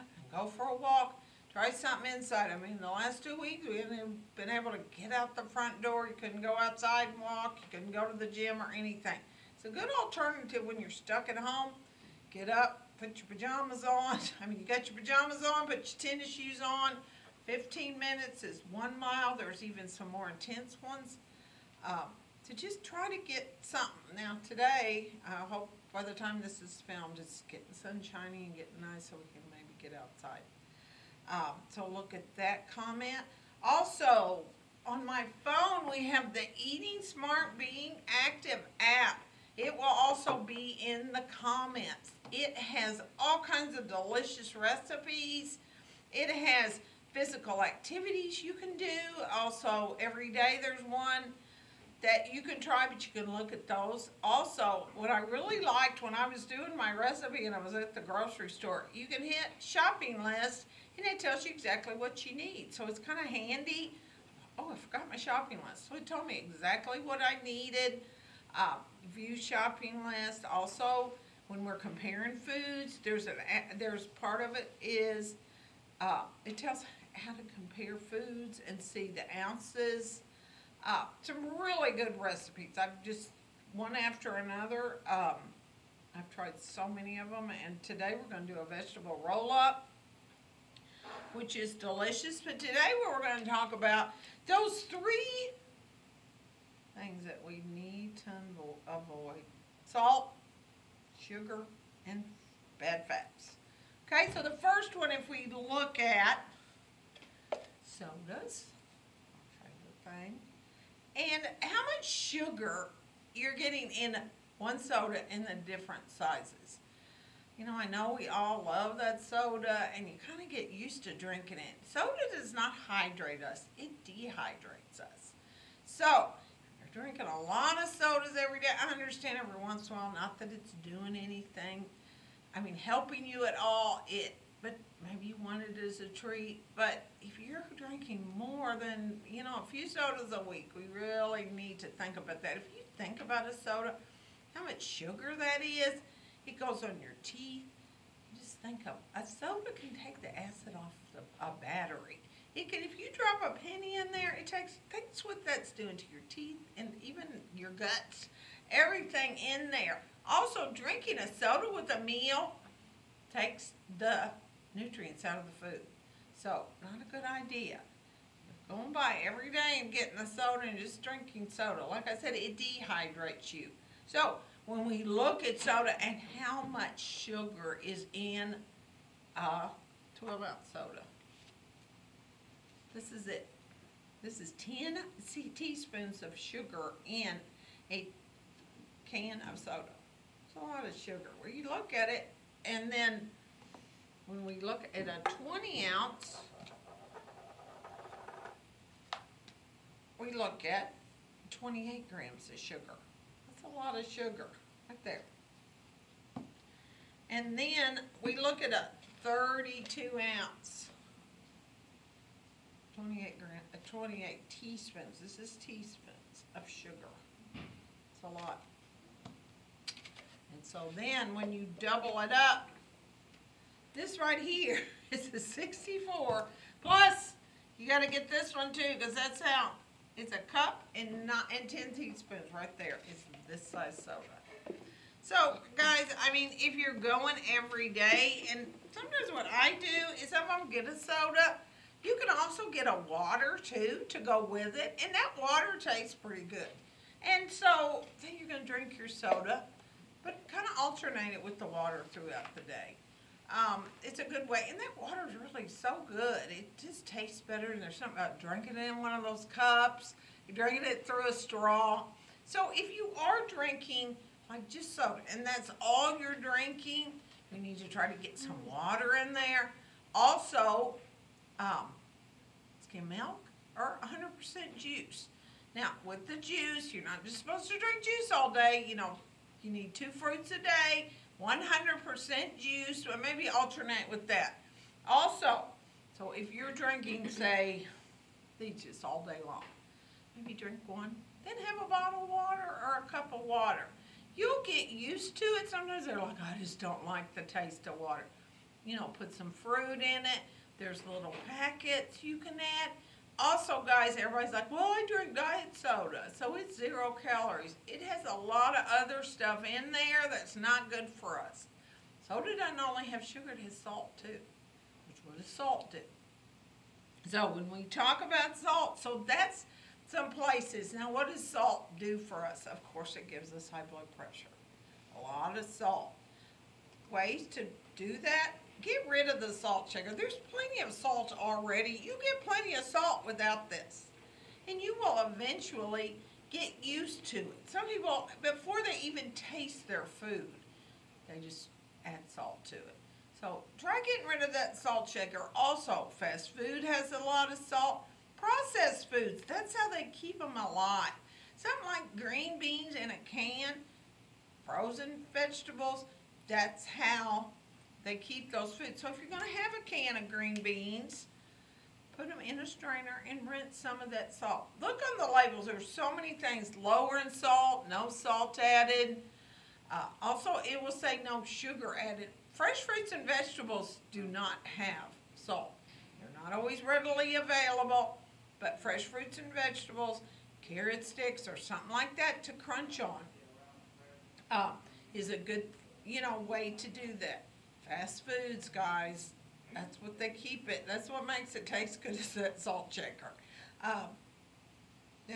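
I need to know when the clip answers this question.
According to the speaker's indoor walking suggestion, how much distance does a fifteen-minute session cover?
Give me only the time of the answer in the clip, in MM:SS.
00:18.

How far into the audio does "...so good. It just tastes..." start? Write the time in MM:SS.
04:15.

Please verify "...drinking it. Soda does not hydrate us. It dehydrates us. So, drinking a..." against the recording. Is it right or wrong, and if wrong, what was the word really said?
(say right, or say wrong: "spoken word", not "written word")
right.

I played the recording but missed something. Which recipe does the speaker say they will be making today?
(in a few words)
vegetable roll up.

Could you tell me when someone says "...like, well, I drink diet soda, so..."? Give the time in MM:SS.
05:04.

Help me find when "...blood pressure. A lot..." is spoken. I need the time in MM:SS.
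05:23.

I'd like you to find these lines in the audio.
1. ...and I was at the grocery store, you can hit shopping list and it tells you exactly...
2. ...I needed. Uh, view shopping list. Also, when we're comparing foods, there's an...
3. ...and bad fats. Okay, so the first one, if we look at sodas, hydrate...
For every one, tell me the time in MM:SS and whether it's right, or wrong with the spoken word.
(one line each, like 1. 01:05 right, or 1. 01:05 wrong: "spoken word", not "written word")
1. 00:57 right
2. 01:07 right
3. 01:42 wrong: "favorite", not "hydrate".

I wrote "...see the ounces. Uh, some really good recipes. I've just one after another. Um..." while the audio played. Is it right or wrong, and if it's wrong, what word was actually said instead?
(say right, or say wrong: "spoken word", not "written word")
right.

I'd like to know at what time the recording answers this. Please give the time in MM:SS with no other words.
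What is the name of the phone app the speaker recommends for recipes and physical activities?
00:36.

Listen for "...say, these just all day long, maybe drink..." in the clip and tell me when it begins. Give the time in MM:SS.
04:47.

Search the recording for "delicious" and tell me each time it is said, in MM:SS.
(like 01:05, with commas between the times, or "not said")
00:43, 01:31.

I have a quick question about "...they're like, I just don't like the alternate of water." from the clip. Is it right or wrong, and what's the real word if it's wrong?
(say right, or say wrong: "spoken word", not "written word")
wrong: "taste", not "alternate".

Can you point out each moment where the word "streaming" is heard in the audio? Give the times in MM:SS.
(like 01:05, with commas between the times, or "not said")
not said.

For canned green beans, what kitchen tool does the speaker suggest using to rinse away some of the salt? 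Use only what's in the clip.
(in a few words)
strainer.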